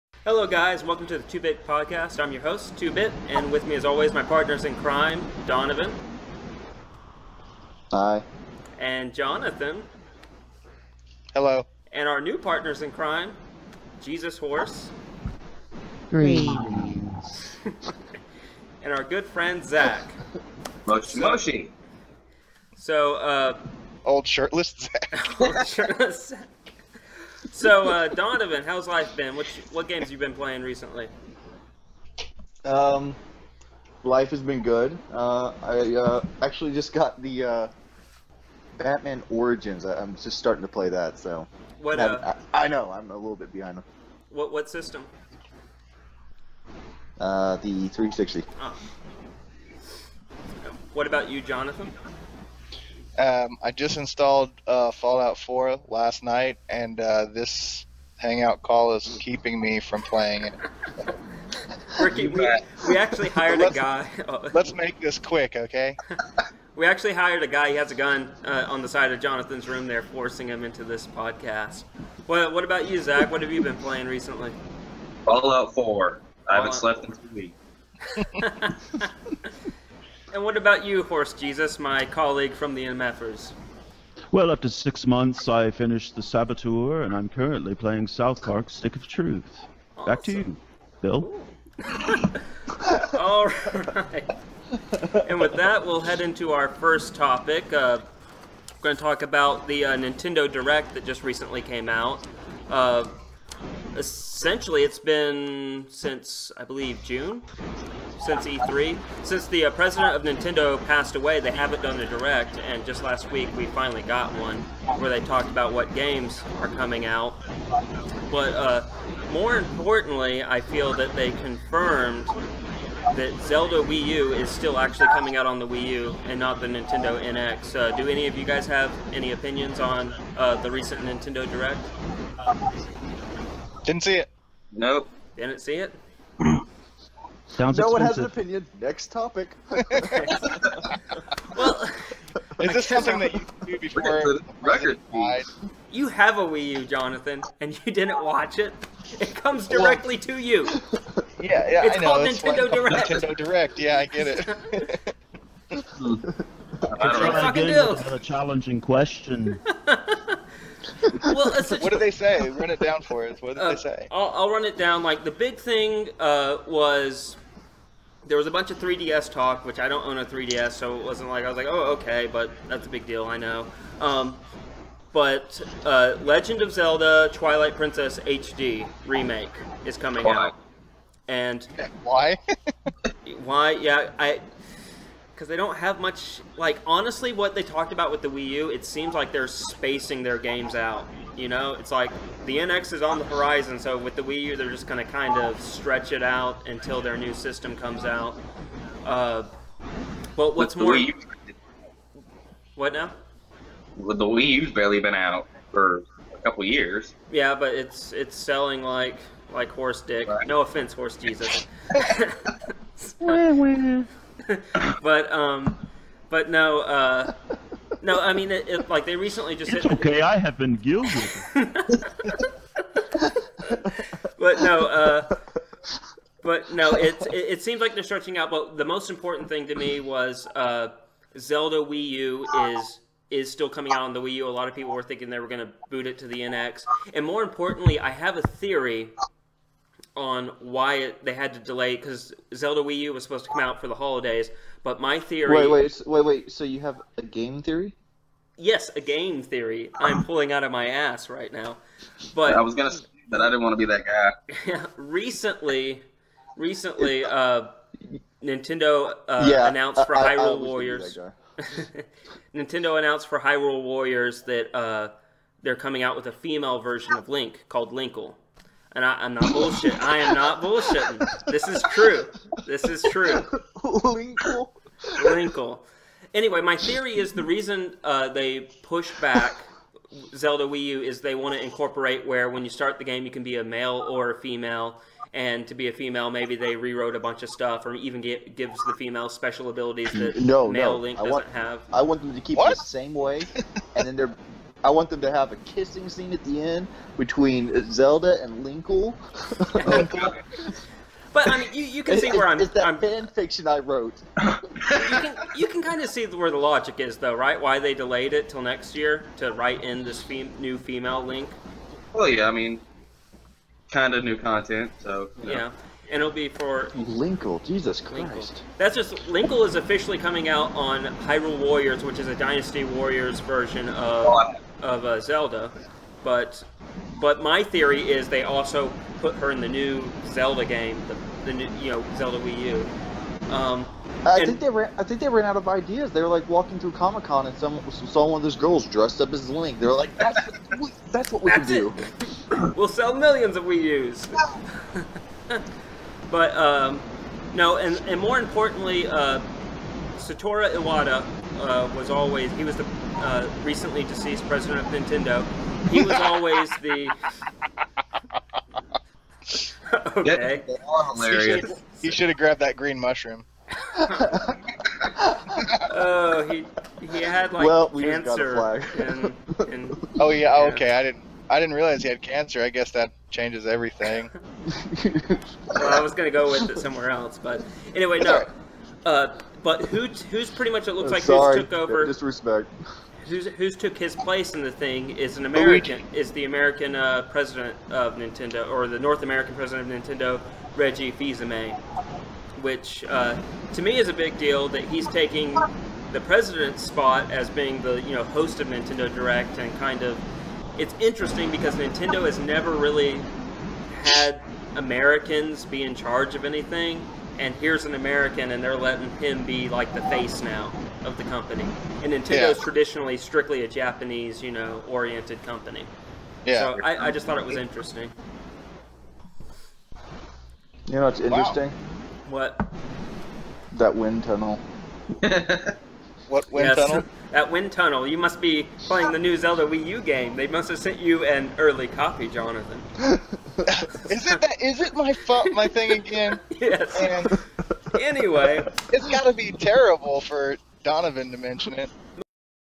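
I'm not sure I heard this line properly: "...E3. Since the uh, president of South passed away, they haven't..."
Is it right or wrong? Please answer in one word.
wrong.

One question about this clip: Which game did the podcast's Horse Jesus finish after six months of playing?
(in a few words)
The Saboteur.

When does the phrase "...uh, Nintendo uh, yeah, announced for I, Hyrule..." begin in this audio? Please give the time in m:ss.
4:17.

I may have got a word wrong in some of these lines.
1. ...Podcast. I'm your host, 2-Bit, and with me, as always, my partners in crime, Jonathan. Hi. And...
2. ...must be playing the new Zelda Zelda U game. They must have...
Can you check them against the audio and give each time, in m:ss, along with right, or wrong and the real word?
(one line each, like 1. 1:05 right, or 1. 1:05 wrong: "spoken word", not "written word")
1. 0:01 wrong: "Donovan", not "Jonathan"
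2. 7:08 wrong: "Wii", not "Zelda".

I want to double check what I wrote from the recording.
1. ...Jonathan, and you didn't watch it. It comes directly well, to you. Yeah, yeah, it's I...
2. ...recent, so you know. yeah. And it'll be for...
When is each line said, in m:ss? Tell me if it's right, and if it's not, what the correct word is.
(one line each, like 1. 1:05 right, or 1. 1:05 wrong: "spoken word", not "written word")
1. 2:26 right
2. 5:14 wrong: "content", not "recent".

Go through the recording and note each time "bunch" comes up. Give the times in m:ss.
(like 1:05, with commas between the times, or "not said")
2:48, 4:47.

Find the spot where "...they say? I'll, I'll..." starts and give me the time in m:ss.
2:43.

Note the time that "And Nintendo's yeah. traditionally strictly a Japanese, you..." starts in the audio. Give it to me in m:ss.
6:52.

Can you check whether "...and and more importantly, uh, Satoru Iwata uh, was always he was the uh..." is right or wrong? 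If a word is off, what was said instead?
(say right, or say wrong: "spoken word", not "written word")
right.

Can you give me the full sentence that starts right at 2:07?
Uh, do any of you guys have any opinions on uh, the recent Nintendo Direct?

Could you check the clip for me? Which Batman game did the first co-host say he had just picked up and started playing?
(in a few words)
Batman Origins.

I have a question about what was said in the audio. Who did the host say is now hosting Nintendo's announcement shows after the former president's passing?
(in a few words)
Reggie Fils-Aimé.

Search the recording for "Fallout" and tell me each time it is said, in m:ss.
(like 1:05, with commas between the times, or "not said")
0:54, 1:15.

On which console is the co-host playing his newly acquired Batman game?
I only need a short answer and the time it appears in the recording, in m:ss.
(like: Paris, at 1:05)
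360, at 0:47.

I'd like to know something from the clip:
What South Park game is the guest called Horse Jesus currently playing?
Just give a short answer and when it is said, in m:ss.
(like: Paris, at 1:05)
South Park Stick of Truth, at 1:28.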